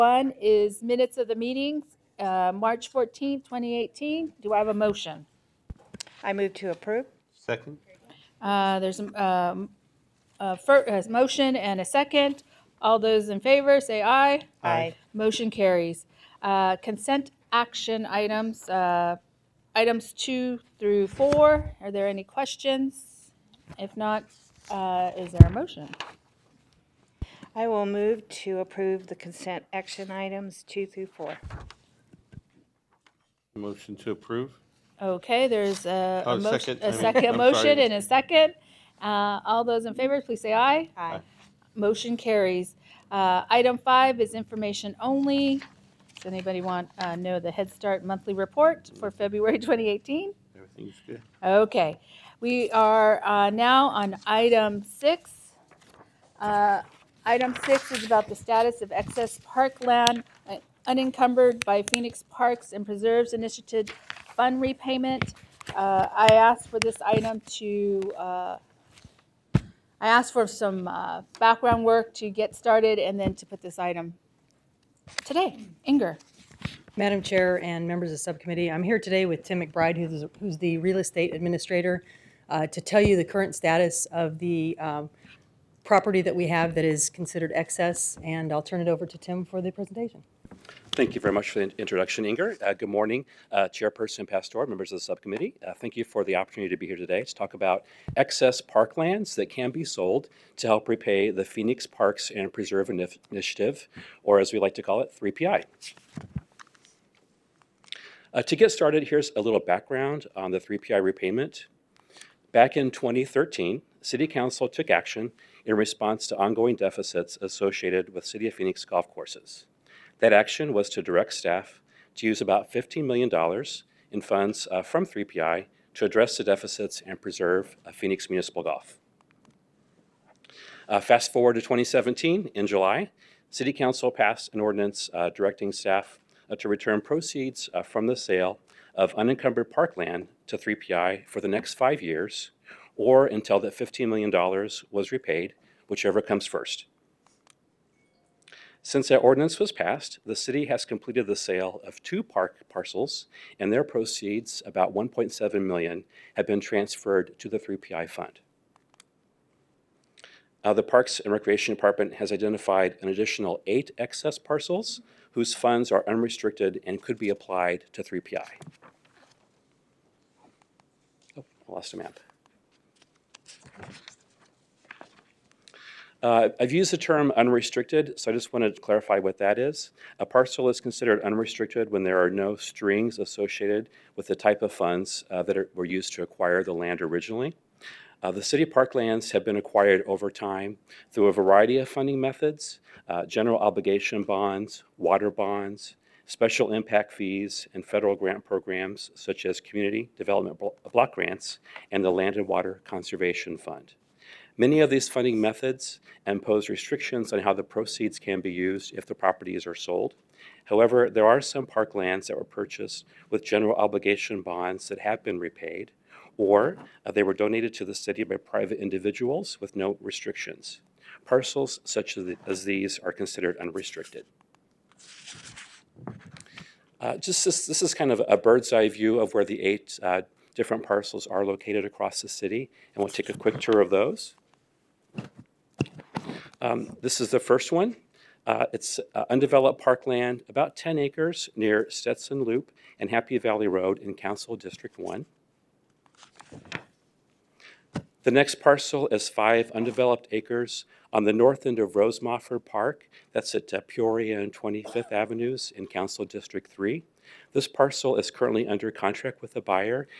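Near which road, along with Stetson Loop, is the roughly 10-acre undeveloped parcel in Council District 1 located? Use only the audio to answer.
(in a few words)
Happy Valley Road.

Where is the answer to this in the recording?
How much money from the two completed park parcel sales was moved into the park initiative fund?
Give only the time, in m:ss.
2:34.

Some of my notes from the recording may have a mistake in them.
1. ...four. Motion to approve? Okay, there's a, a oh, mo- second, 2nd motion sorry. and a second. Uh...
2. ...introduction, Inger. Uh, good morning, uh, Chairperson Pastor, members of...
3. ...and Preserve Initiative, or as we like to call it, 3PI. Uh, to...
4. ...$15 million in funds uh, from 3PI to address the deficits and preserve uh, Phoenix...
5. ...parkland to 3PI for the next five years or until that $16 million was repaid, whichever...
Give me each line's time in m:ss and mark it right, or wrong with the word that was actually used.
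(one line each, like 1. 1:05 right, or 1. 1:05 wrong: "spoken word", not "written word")
1. 0:31 right
2. 1:31 right
3. 1:42 right
4. 2:02 right
5. 2:19 wrong: "15", not "16".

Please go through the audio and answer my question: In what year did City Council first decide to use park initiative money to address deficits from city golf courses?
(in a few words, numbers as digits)
2013.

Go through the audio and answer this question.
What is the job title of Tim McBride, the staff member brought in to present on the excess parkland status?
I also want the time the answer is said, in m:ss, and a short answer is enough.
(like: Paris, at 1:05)
real estate administrator, at 1:20.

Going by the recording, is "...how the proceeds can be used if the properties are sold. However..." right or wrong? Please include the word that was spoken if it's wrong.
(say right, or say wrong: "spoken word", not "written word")
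right.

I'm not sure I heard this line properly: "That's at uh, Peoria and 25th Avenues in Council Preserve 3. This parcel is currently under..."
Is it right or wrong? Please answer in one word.
wrong.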